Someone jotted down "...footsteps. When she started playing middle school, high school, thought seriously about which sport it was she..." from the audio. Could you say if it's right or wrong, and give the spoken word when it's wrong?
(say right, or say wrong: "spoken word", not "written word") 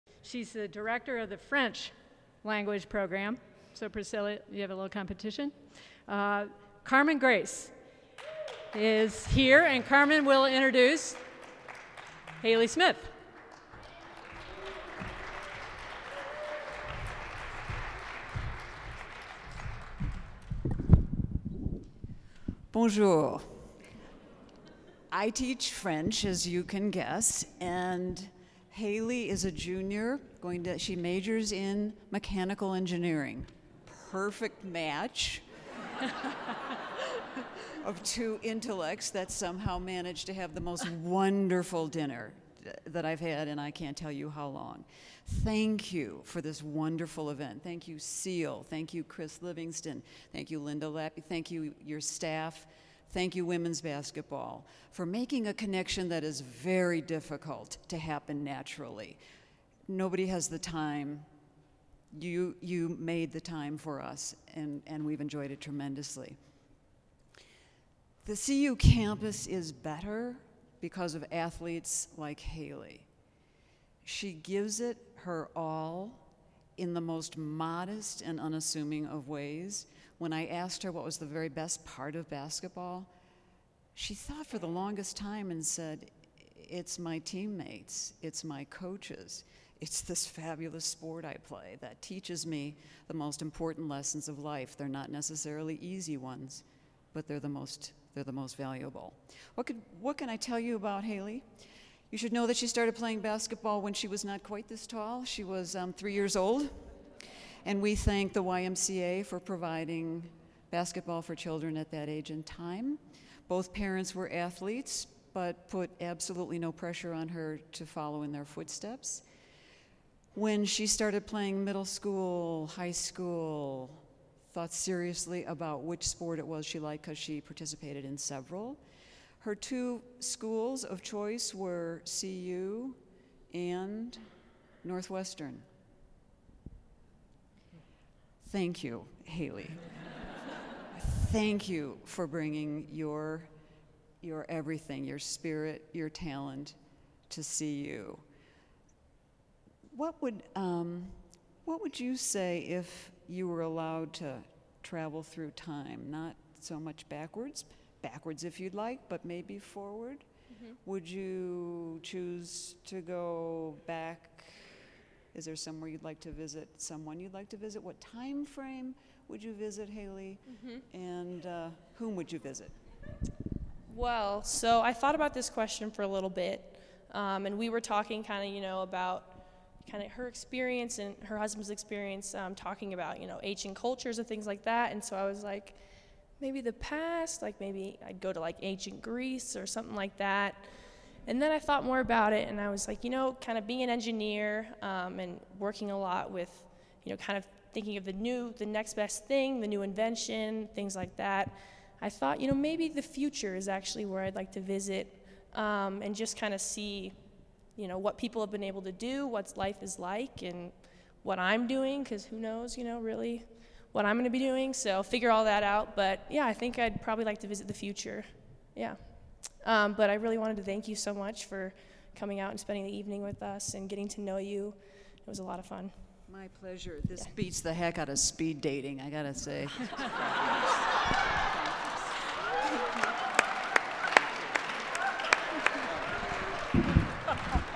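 right.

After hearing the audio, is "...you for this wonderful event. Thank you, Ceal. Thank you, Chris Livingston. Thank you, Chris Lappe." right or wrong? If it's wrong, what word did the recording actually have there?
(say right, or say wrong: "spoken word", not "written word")
wrong: "Linda", not "Chris".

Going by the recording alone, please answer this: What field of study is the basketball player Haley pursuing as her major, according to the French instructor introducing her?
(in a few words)
Mechanical engineering.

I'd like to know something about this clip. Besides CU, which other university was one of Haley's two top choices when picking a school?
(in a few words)
Northwestern.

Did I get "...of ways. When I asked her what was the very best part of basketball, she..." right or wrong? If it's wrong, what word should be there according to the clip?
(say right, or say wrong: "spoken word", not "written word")
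right.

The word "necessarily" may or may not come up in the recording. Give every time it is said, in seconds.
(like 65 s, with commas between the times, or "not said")
95 s.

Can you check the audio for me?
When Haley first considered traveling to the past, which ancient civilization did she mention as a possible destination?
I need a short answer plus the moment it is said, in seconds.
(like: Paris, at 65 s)
Ancient Greece, at 188 s.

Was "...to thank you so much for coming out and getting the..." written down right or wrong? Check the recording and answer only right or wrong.
wrong.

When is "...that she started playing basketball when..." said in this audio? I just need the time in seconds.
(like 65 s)
102 s.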